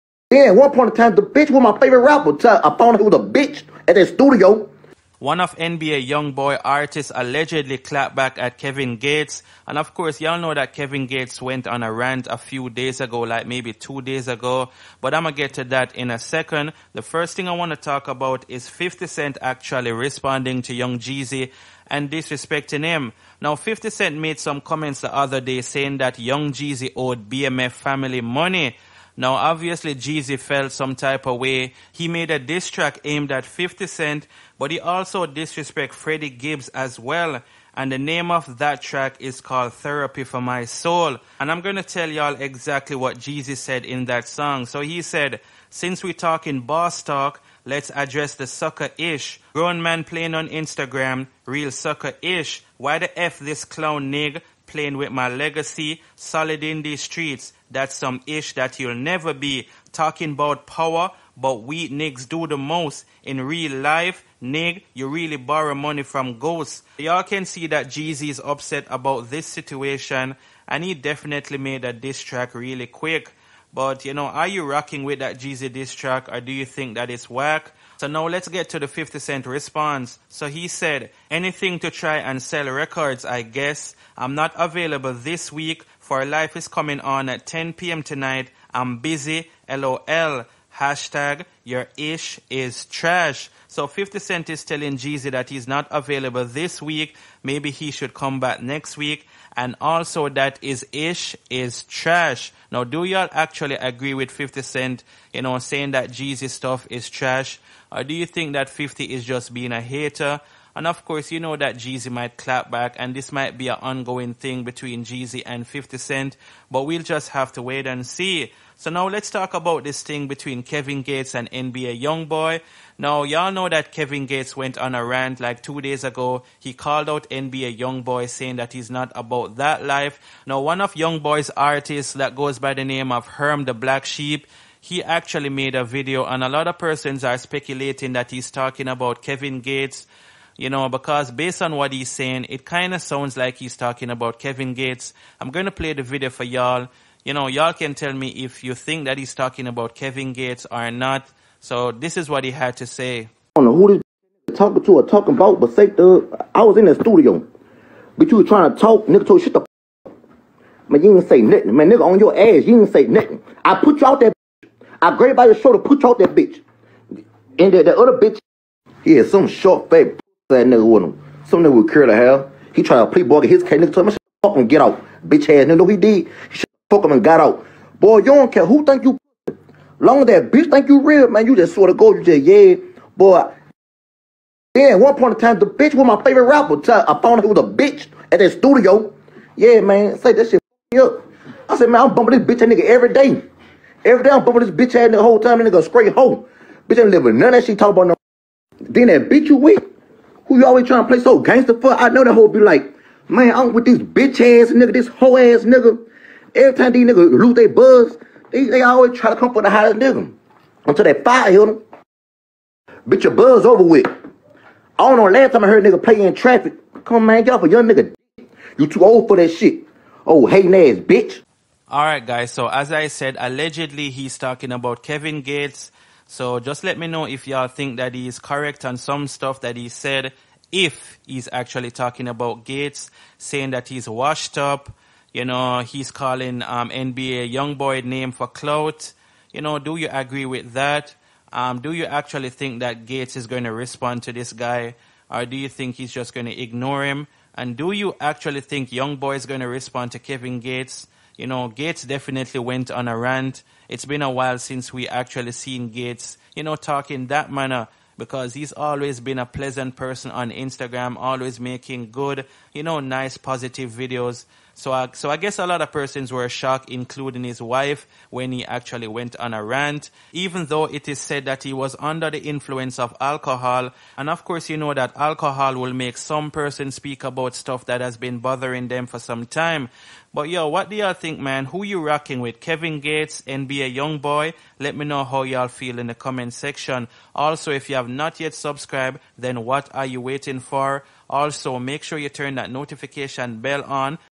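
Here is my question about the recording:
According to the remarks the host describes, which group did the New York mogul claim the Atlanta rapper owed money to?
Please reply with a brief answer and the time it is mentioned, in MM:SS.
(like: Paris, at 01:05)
BMF family, at 00:27.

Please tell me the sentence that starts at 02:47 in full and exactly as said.
And the, the other bitch, he had some short fat that nigga with him.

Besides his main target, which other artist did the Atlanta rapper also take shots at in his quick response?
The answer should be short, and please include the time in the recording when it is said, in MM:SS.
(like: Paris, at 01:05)
Freddie Gibbs, at 00:35.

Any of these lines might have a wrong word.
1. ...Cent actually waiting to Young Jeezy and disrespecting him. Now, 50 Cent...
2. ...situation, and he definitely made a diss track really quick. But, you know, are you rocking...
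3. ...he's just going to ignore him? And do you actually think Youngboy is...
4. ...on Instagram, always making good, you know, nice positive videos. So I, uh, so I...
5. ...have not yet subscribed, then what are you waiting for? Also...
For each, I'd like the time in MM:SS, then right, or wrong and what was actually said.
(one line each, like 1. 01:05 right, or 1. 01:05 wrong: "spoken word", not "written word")
1. 00:19 wrong: "responding", not "waiting"
2. 01:09 right
3. 04:05 right
4. 04:20 right
5. 04:47 right.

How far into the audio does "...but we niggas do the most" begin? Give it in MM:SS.
01:01.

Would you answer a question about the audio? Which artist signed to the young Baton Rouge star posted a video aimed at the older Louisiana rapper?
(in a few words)
Herm the Black Sheep.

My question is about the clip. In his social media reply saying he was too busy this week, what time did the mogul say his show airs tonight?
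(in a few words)
10 p.m.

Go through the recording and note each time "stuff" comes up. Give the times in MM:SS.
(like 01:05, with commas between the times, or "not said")
01:46, 03:49, 04:37.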